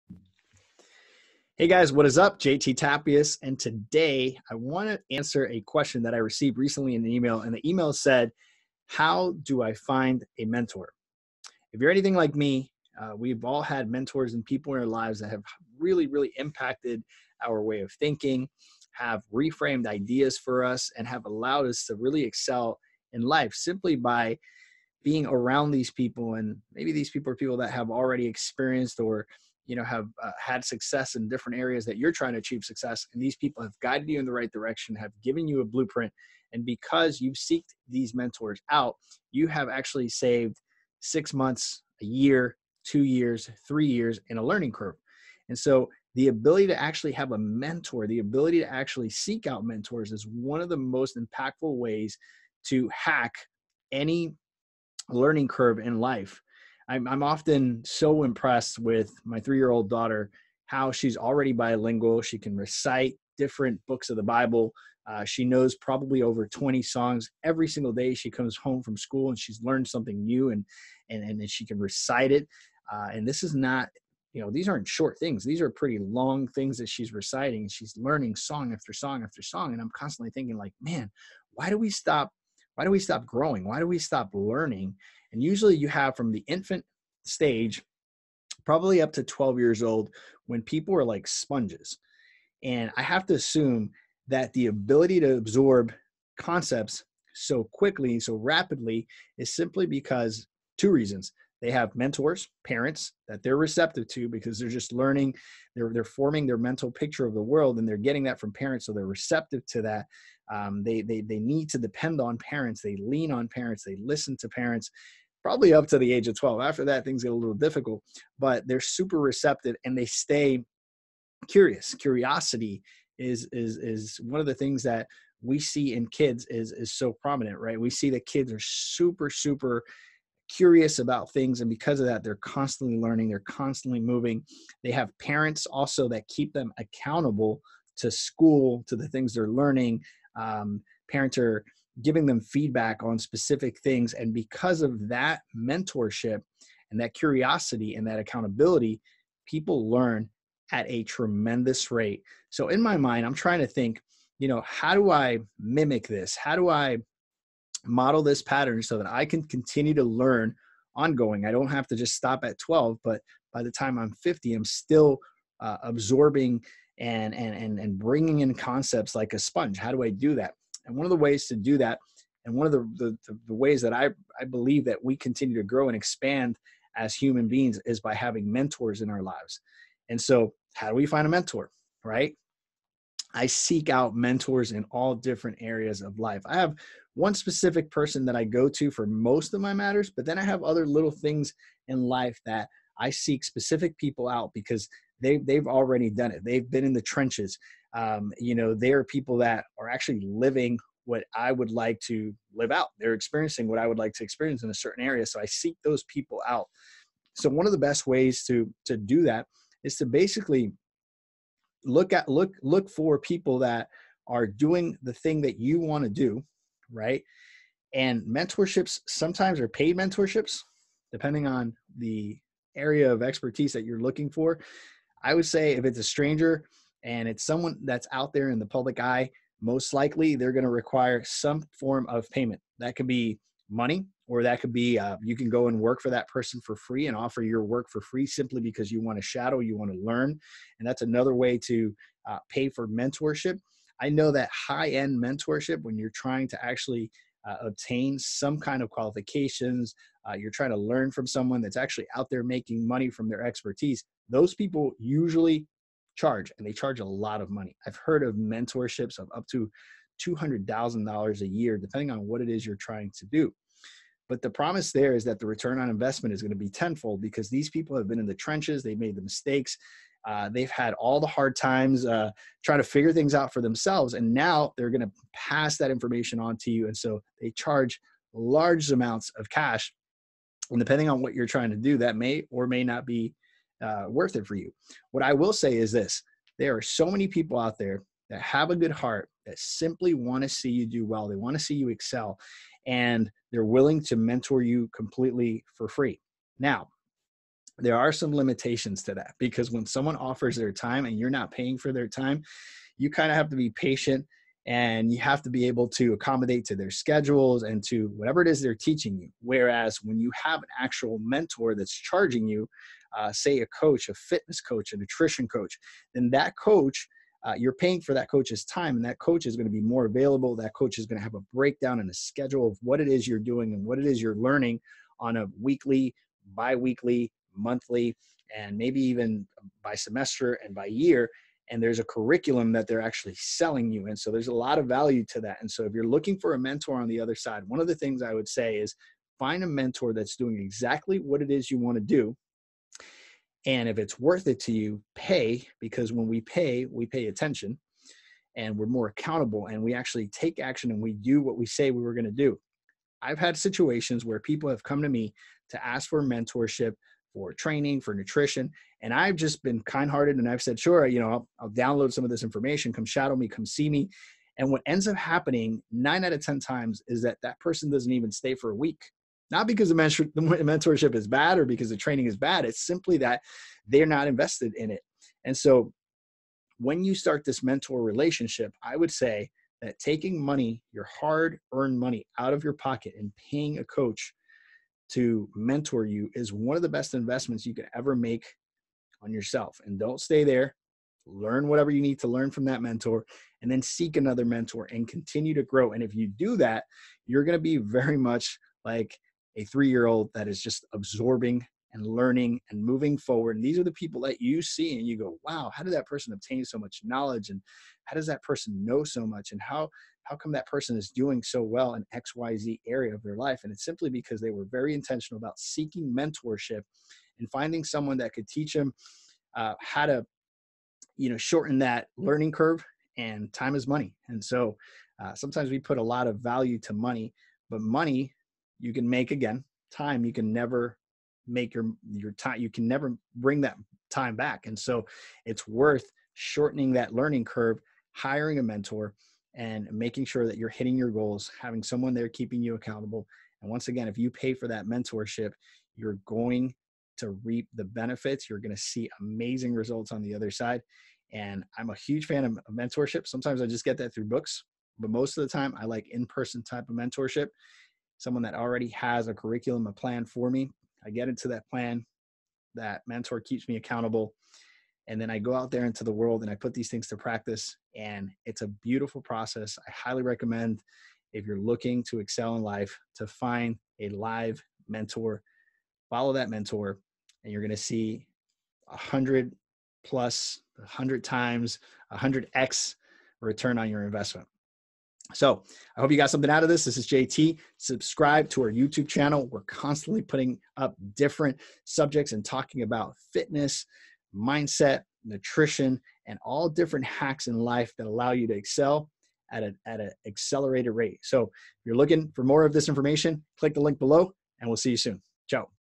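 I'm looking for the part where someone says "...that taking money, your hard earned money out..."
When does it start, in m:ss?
6:19.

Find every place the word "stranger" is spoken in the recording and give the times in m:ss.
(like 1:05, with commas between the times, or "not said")
3:46.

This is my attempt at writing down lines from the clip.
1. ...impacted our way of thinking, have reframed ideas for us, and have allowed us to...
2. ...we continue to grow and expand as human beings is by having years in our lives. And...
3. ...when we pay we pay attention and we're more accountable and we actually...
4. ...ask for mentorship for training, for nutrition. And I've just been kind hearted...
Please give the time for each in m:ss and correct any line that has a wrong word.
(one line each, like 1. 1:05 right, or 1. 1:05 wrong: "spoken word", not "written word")
1. 0:16 right
2. 2:55 wrong: "mentors", not "years"
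3. 5:46 right
4. 5:55 right.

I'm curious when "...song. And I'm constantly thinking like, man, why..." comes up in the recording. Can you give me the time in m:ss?
1:19.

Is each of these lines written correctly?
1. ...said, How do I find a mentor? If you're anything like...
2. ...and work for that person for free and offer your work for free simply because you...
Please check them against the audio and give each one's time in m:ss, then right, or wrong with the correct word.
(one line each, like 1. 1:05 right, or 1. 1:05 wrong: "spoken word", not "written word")
1. 0:07 right
2. 3:55 right.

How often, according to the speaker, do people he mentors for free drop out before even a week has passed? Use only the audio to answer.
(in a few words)
9 out of 10 times.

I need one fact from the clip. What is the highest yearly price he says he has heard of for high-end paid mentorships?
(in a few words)
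$200,000.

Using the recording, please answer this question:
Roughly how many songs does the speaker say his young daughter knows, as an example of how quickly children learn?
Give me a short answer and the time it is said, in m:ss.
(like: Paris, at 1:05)
over 20, at 1:06.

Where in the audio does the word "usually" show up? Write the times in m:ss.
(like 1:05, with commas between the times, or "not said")
1:25, 4:14.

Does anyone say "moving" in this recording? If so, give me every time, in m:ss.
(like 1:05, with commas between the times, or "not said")
2:14, 6:42.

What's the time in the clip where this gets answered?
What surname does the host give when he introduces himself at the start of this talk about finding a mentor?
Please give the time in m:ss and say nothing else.
0:02.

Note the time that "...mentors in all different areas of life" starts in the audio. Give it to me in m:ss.
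3:04.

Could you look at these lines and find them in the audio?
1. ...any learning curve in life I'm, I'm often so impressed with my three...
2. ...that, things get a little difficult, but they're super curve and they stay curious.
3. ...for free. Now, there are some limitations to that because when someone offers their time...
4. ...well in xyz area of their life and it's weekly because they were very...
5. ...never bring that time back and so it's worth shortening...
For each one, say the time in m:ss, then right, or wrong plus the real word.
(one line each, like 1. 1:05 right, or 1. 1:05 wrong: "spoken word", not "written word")
1. 0:53 right
2. 1:56 wrong: "receptive", not "curve"
3. 4:55 right
4. 6:51 wrong: "simply", not "weekly"
5. 7:12 right.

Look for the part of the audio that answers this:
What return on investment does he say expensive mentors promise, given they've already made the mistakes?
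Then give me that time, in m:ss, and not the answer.
4:26.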